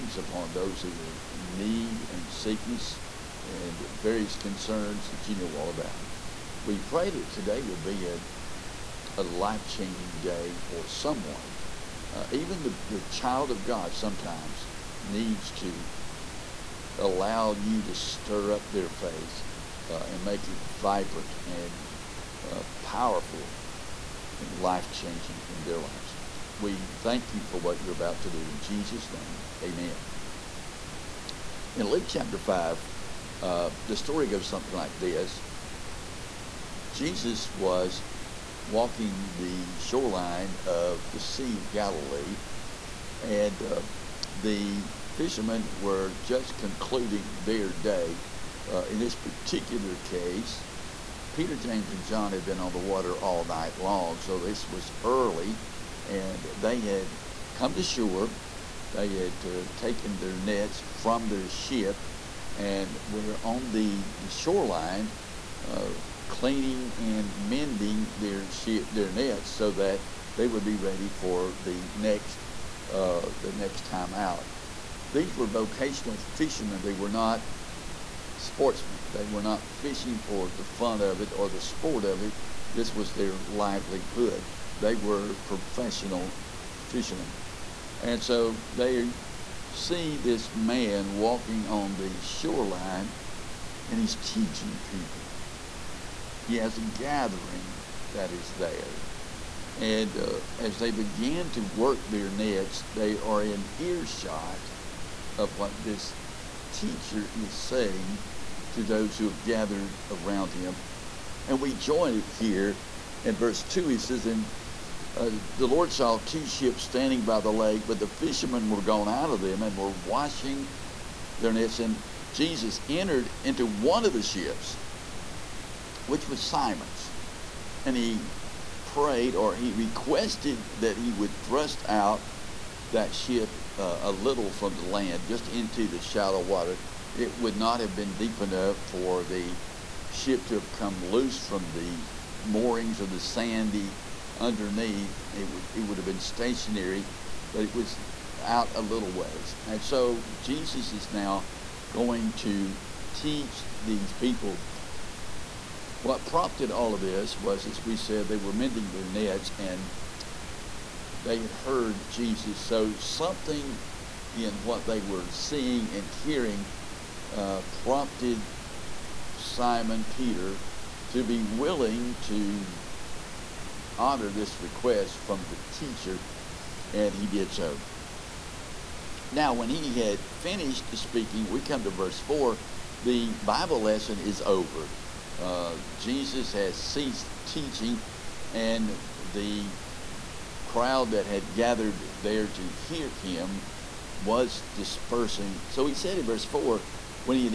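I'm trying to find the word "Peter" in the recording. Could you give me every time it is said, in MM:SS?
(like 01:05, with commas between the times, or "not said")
00:51, 02:50.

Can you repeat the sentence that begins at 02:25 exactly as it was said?
It would, it would have been stationary, but it was out a little ways.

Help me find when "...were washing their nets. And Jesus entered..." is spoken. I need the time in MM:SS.
01:59.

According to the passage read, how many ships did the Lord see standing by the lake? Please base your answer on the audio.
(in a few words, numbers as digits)
2.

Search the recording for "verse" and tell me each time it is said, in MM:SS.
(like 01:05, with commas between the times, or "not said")
01:53, 03:01, 03:16.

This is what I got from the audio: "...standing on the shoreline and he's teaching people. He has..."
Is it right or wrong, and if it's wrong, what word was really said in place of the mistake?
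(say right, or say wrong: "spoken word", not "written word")
wrong: "walking", not "standing".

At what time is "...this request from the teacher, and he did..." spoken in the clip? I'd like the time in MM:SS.
02:54.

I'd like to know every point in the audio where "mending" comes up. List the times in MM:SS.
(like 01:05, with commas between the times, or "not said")
01:07, 02:38.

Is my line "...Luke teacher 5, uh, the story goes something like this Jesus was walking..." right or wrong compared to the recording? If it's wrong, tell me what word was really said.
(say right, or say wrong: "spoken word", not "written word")
wrong: "chapter", not "teacher".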